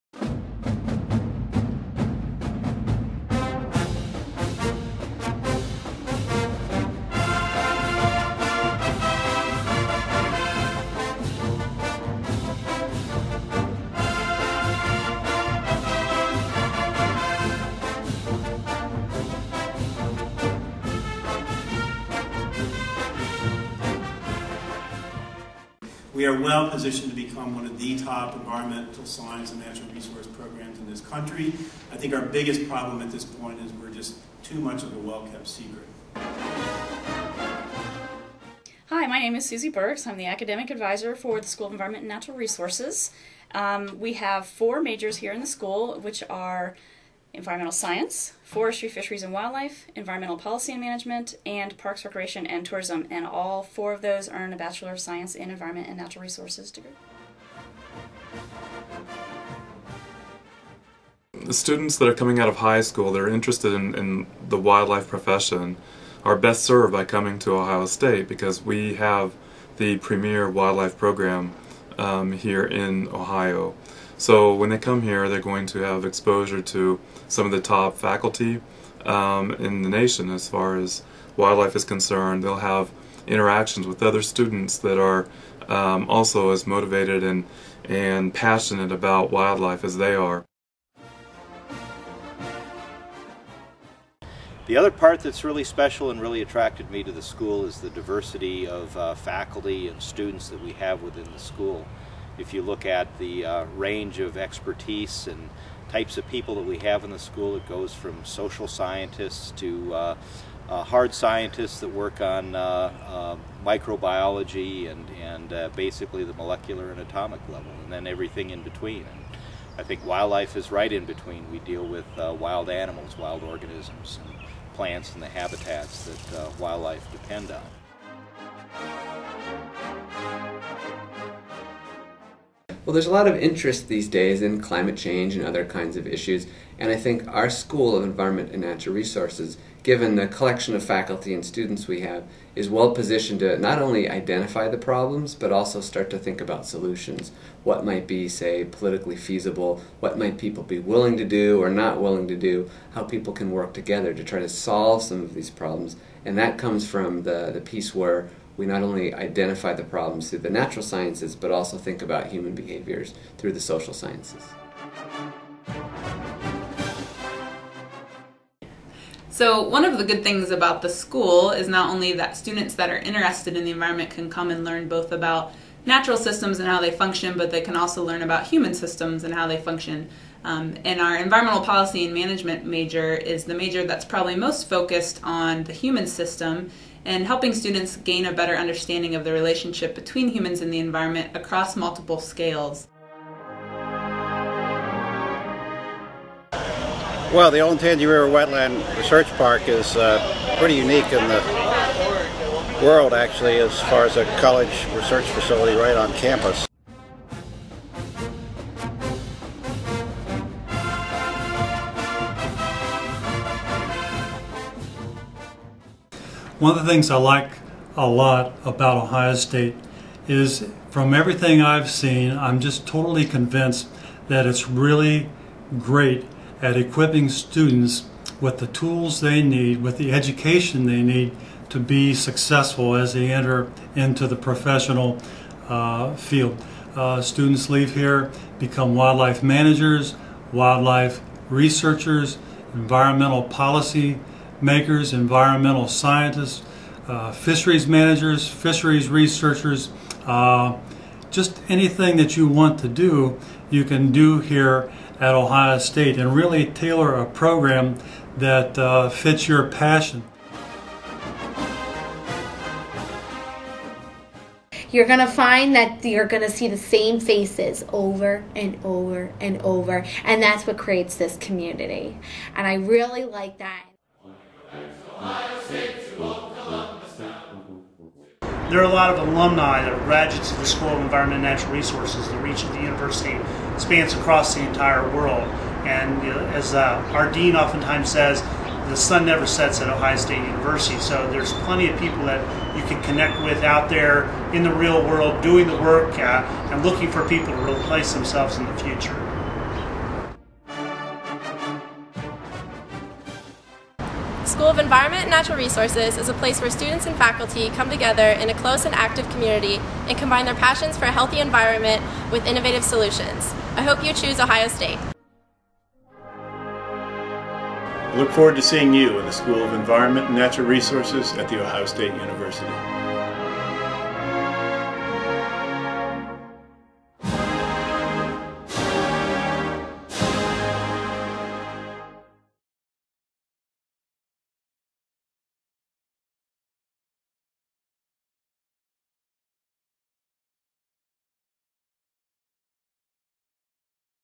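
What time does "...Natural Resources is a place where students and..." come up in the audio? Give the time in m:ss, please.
5:05.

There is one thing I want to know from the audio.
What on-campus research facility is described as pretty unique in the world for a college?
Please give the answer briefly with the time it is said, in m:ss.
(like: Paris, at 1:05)
Olentangy River Wetland Research Park, at 3:17.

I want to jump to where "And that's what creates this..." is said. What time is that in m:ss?
4:30.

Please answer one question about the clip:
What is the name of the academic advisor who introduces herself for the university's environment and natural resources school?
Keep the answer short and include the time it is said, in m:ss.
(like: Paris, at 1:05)
Susie Burks, at 0:39.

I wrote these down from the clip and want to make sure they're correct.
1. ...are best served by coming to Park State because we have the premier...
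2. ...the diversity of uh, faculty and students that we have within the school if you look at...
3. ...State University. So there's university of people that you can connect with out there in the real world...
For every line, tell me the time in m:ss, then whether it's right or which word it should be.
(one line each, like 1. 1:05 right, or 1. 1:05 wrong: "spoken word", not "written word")
1. 1:06 wrong: "Ohio", not "Park"
2. 1:37 right
3. 4:50 wrong: "plenty", not "university".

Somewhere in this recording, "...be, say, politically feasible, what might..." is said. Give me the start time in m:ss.
2:28.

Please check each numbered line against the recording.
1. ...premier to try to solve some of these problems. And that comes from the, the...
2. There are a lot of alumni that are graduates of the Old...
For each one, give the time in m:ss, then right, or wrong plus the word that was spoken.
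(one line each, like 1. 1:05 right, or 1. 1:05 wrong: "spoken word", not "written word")
1. 2:33 wrong: "together", not "premier"
2. 4:38 wrong: "School", not "Old".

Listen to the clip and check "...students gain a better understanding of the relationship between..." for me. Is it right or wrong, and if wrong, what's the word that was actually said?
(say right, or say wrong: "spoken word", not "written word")
right.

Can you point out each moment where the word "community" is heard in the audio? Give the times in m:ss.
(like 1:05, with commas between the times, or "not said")
4:31, 5:09.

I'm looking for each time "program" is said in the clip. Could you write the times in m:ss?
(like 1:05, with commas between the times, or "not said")
0:30, 1:10, 4:17.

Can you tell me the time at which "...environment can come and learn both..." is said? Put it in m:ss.
2:53.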